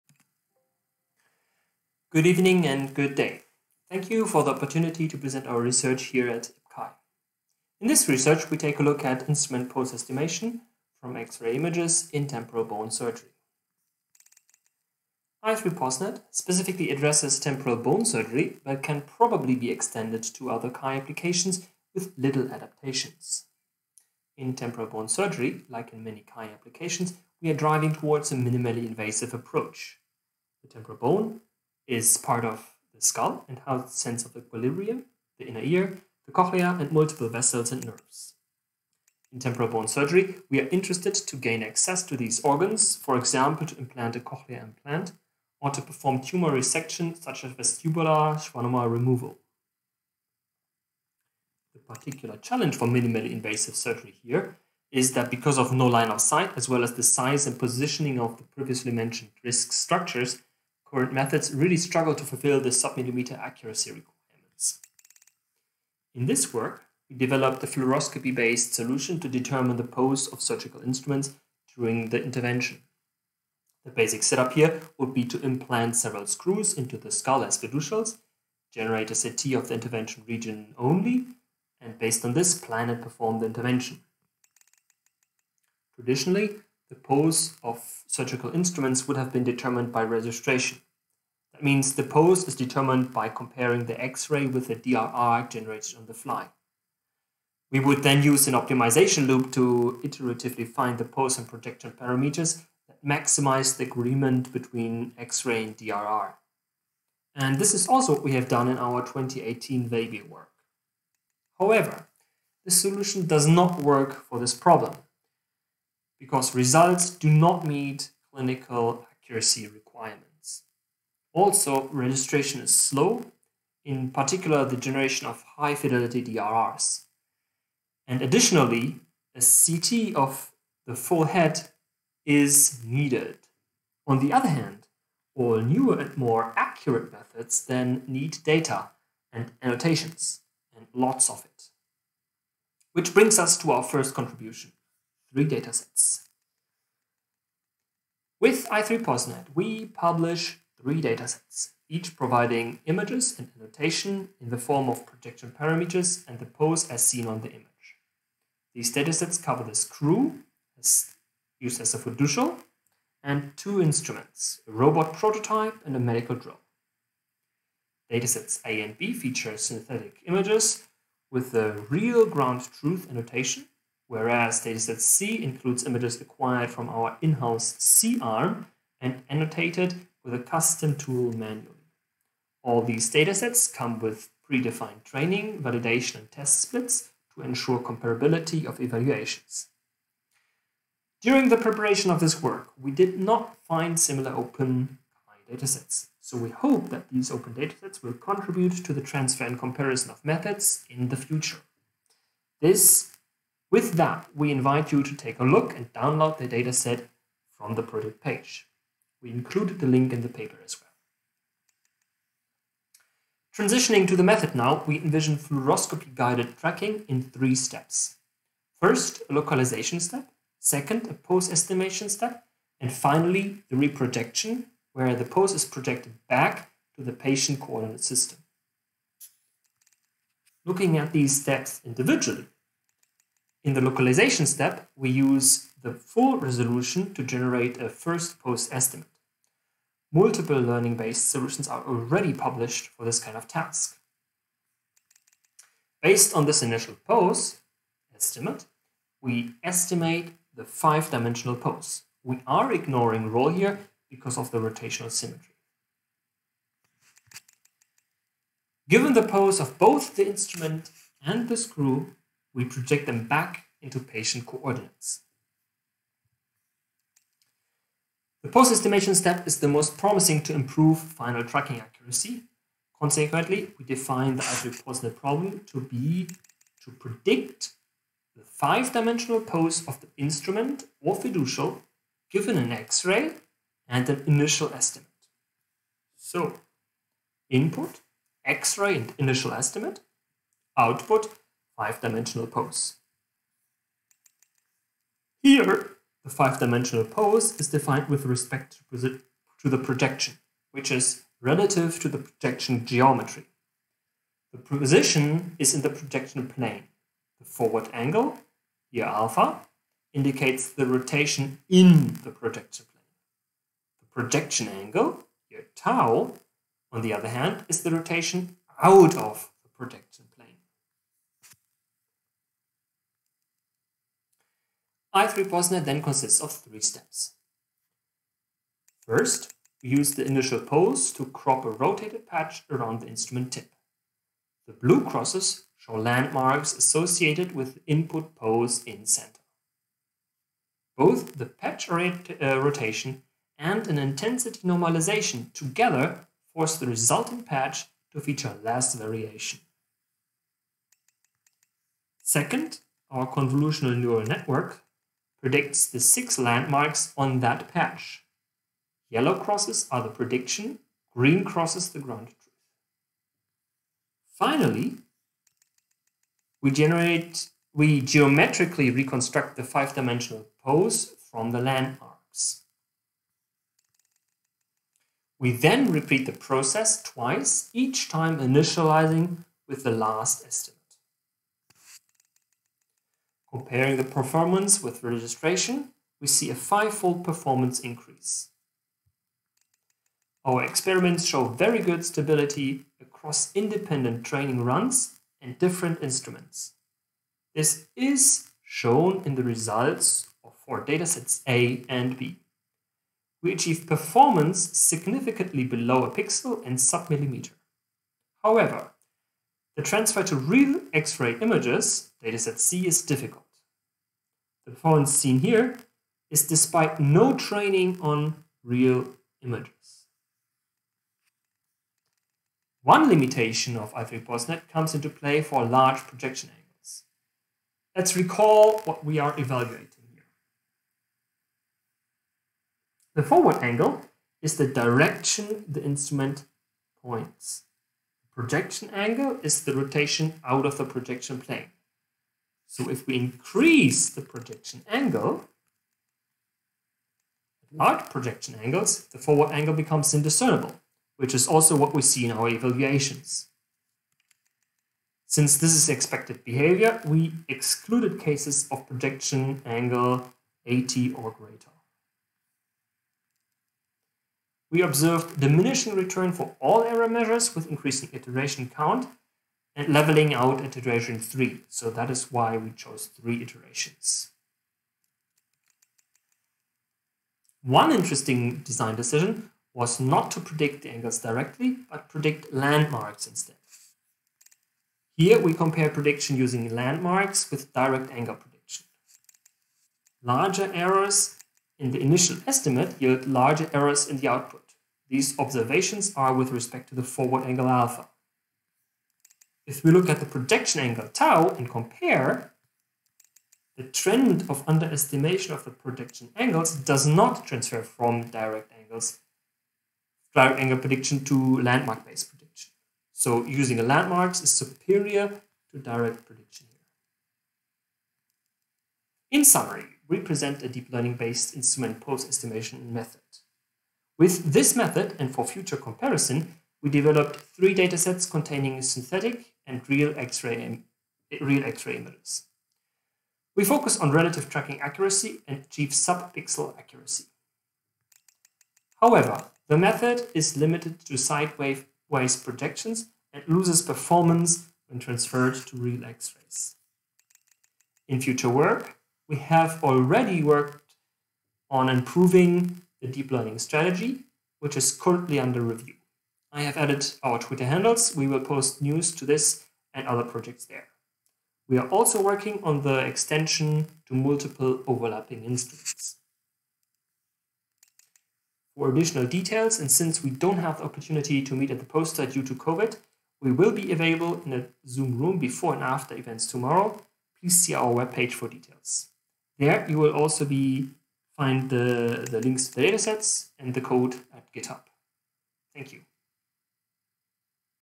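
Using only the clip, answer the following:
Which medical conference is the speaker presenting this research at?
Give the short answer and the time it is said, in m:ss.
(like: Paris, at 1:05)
IPCAI, at 0:06.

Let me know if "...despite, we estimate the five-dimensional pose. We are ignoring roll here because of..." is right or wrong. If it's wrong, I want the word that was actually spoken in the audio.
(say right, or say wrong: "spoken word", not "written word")
wrong: "estimate", not "despite".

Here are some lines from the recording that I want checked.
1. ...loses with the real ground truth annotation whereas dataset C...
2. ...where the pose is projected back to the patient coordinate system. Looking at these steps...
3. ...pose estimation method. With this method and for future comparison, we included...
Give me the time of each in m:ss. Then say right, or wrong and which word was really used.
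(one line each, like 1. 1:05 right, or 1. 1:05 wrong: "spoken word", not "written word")
1. 2:50 wrong: "images", not "loses"
2. 3:44 right
3. 8:42 wrong: "developed", not "included".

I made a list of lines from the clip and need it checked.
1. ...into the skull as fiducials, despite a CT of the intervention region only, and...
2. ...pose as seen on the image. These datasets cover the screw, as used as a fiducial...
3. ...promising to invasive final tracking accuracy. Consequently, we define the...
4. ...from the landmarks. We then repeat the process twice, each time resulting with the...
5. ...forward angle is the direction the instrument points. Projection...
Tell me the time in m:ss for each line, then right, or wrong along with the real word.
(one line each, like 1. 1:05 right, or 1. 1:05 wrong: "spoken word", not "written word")
1. 1:16 wrong: "generate", not "despite"
2. 2:36 right
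3. 4:29 wrong: "improve", not "invasive"
4. 6:11 wrong: "initializing", not "resulting"
5. 7:13 right.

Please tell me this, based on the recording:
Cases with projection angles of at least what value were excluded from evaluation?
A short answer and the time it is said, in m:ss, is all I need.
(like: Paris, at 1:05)
80, at 7:40.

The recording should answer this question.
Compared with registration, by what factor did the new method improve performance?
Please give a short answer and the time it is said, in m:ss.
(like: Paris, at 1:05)
fivefold, at 6:26.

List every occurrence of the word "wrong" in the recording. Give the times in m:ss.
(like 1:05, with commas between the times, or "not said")
not said.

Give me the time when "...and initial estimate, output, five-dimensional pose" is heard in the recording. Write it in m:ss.
4:48.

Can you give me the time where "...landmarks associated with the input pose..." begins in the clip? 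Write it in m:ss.
5:35.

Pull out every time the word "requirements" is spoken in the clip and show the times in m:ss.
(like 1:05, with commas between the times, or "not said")
1:03, 1:59.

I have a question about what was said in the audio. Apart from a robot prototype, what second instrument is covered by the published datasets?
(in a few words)
a medical drone.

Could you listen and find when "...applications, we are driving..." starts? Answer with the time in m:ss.
0:26.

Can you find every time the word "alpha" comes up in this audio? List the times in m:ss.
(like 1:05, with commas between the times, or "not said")
5:09, 8:17.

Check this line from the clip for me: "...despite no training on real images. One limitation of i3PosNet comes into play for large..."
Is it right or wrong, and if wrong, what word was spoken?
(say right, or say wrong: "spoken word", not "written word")
right.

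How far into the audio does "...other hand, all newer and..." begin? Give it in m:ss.
2:14.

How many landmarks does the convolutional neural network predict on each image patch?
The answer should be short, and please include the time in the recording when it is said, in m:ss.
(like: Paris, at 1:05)
6, at 5:55.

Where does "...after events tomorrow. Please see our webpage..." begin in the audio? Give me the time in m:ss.
9:35.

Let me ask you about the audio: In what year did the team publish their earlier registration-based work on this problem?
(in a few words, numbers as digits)
2018.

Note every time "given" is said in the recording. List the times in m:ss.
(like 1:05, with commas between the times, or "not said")
4:18, 4:42.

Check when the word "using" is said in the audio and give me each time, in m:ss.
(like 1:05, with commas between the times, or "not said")
8:06, 8:33.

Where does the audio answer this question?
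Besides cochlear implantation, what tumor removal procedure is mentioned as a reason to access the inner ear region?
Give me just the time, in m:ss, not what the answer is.
0:47.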